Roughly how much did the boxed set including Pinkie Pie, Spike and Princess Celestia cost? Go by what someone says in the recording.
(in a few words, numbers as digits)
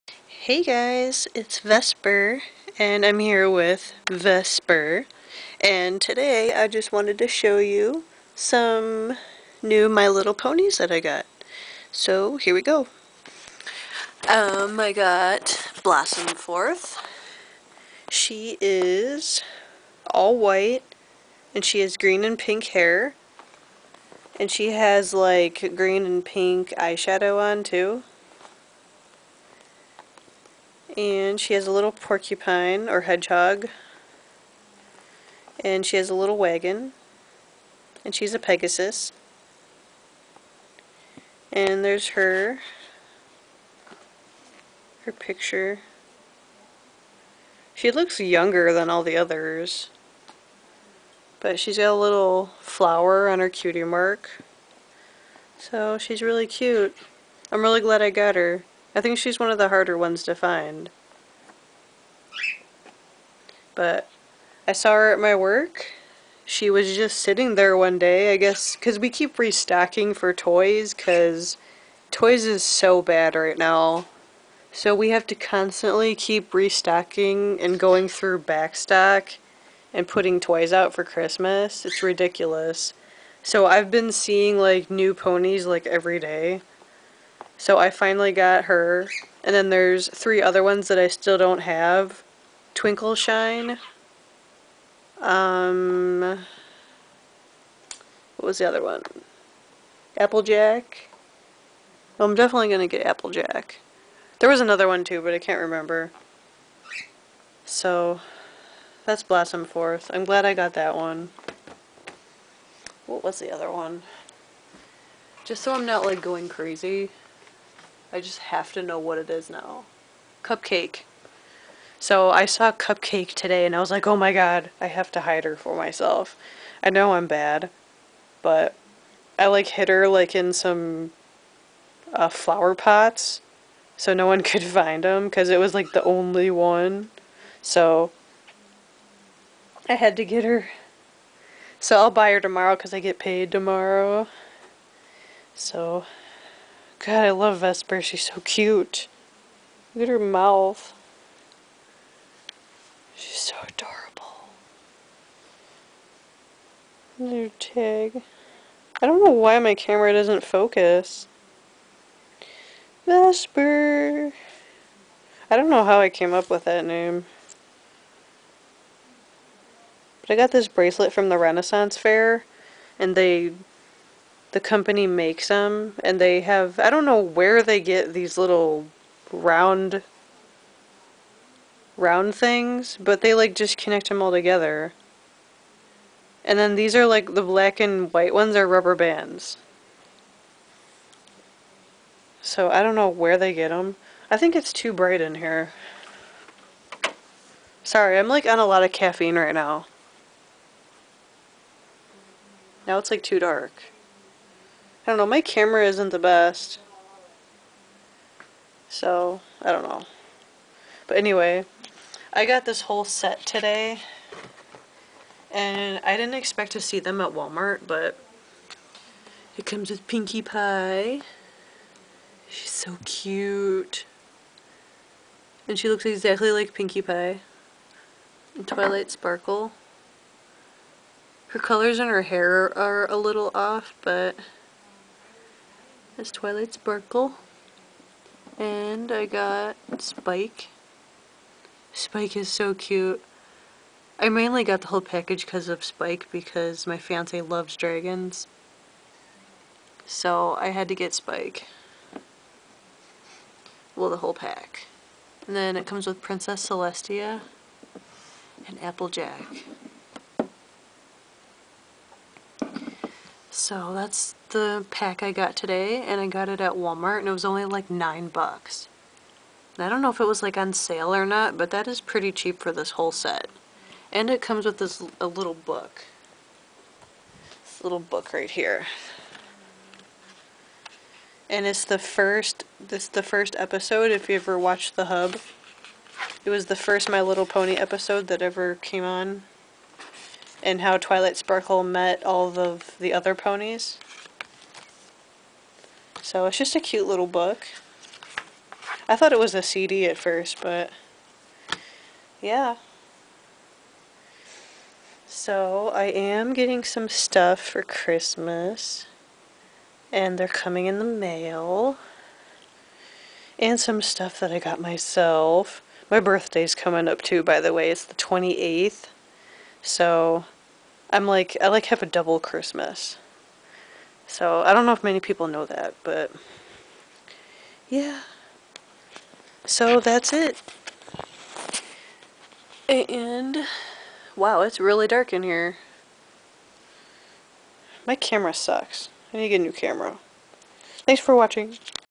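9 bucks.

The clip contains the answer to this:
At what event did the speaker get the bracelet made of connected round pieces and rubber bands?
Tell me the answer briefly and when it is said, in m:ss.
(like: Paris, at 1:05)
Renaissance Fair, at 2:51.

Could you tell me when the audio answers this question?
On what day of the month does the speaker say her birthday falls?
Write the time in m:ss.
5:18.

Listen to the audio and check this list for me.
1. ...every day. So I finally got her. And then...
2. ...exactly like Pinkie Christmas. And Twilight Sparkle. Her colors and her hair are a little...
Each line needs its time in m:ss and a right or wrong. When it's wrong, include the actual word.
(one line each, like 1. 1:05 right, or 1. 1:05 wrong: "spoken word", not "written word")
1. 1:25 right
2. 3:46 wrong: "Pie", not "Christmas".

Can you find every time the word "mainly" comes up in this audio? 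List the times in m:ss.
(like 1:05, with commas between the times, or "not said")
4:04.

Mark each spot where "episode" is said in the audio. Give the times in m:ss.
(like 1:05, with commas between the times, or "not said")
4:43, 4:47.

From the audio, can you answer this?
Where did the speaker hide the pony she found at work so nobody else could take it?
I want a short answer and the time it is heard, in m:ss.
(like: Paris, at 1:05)
flower pots, at 2:12.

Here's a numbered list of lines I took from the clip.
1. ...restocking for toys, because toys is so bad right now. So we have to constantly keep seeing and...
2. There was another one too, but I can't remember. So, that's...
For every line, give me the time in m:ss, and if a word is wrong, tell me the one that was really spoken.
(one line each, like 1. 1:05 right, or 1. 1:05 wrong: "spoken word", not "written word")
1. 1:09 wrong: "restocking", not "seeing"
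2. 1:44 right.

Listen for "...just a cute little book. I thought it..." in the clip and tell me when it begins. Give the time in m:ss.
4:56.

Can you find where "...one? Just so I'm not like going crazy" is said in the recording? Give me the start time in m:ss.
1:53.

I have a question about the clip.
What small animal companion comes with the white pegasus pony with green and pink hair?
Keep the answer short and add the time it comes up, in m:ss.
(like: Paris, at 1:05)
porcupine or hedgehog, at 0:31.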